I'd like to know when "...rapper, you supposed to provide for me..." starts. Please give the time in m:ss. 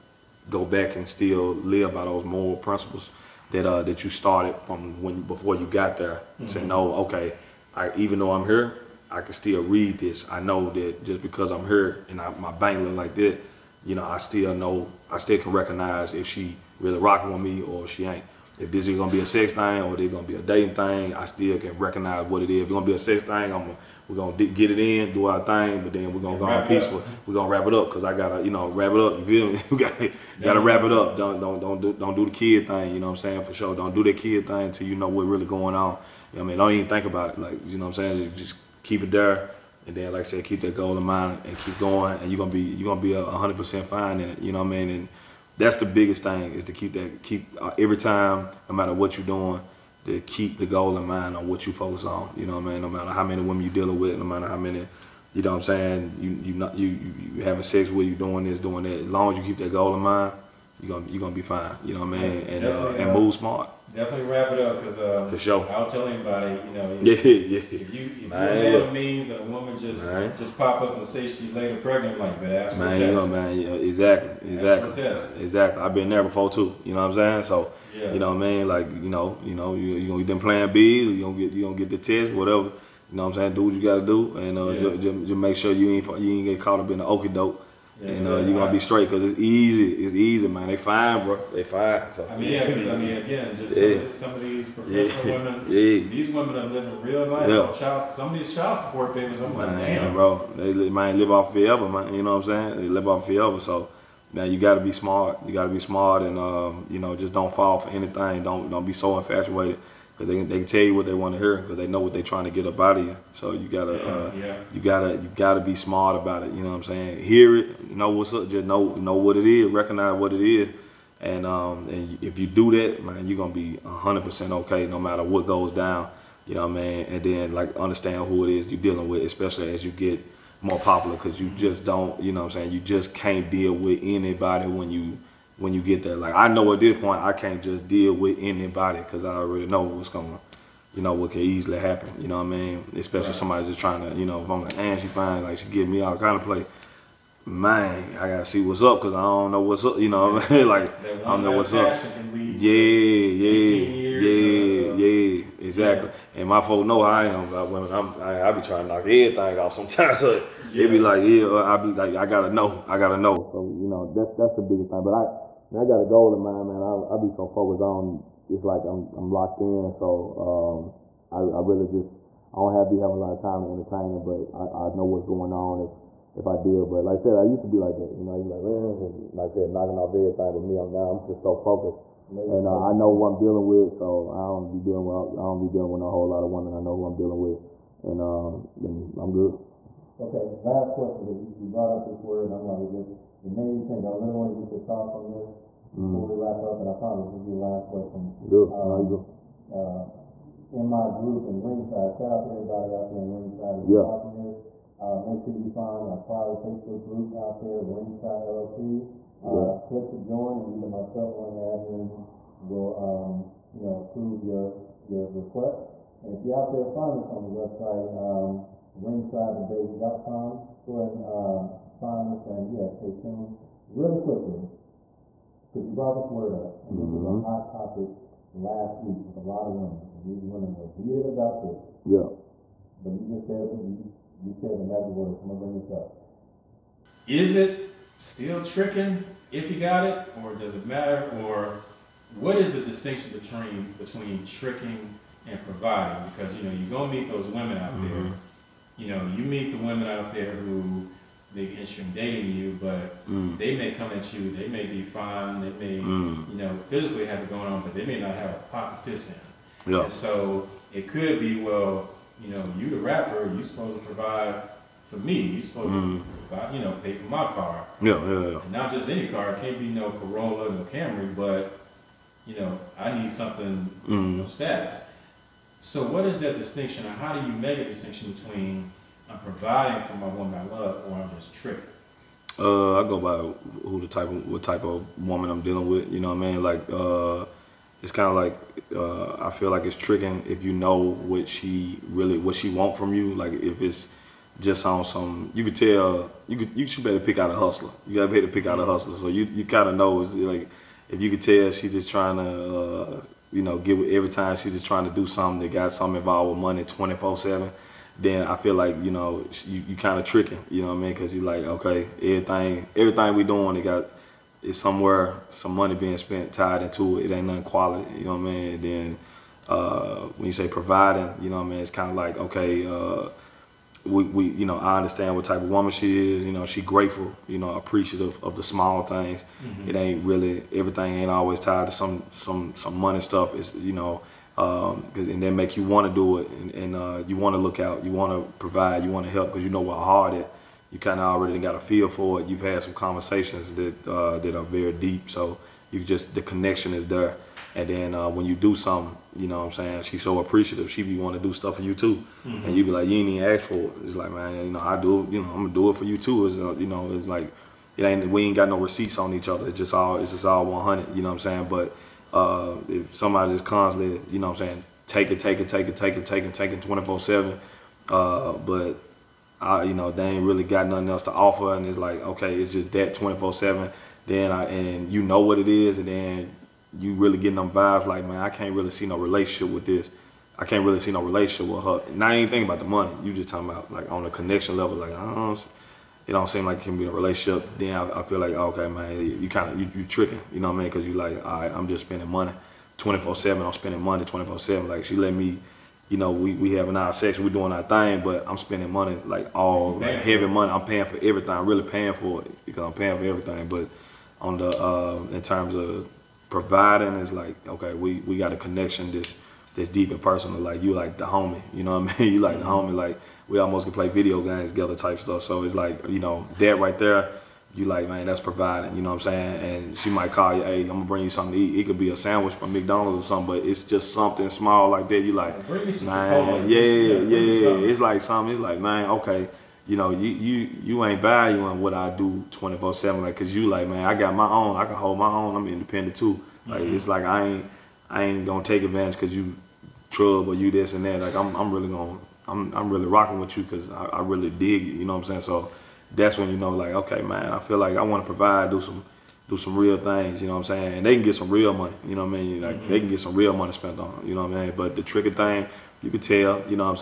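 4:22.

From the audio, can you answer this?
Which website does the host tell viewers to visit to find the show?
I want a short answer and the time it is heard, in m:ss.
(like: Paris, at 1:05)
ringsidedebates.com, at 3:39.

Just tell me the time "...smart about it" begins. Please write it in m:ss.
1:55.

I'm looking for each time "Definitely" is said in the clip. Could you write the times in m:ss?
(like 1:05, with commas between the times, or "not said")
1:03.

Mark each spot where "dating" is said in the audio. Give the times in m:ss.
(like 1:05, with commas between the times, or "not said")
0:20, 4:12.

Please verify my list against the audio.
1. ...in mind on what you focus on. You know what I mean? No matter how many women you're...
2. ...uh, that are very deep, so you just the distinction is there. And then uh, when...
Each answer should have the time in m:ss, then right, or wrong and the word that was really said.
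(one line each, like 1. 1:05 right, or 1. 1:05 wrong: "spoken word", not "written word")
1. 0:50 right
2. 5:44 wrong: "connection", not "distinction".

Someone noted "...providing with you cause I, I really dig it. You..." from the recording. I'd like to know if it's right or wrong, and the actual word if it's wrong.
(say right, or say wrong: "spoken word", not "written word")
wrong: "rocking", not "providing".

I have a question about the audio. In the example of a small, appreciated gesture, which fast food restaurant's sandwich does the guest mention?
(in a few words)
McDonald's.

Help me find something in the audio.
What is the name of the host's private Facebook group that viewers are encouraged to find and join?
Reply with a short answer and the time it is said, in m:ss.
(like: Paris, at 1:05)
Ringside LLC, at 3:27.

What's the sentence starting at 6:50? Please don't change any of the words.
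Like you like the homie, you know what I mean?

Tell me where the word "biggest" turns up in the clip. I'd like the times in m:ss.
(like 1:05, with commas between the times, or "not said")
0:45, 2:44.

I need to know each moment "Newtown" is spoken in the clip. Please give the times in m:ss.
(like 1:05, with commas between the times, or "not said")
not said.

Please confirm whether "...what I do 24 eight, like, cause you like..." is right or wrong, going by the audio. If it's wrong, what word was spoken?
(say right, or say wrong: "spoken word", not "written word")
wrong: "seven", not "eight".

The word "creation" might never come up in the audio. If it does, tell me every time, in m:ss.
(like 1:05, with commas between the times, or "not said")
not said.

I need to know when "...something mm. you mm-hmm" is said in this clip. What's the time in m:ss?
4:33.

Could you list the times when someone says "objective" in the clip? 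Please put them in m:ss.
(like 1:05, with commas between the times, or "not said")
not said.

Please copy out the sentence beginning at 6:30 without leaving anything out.
Because you like, all right, I'm just spending money, 24 seven.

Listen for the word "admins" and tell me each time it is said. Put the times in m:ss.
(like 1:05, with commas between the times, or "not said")
3:31.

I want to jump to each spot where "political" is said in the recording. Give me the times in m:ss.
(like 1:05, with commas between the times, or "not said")
not said.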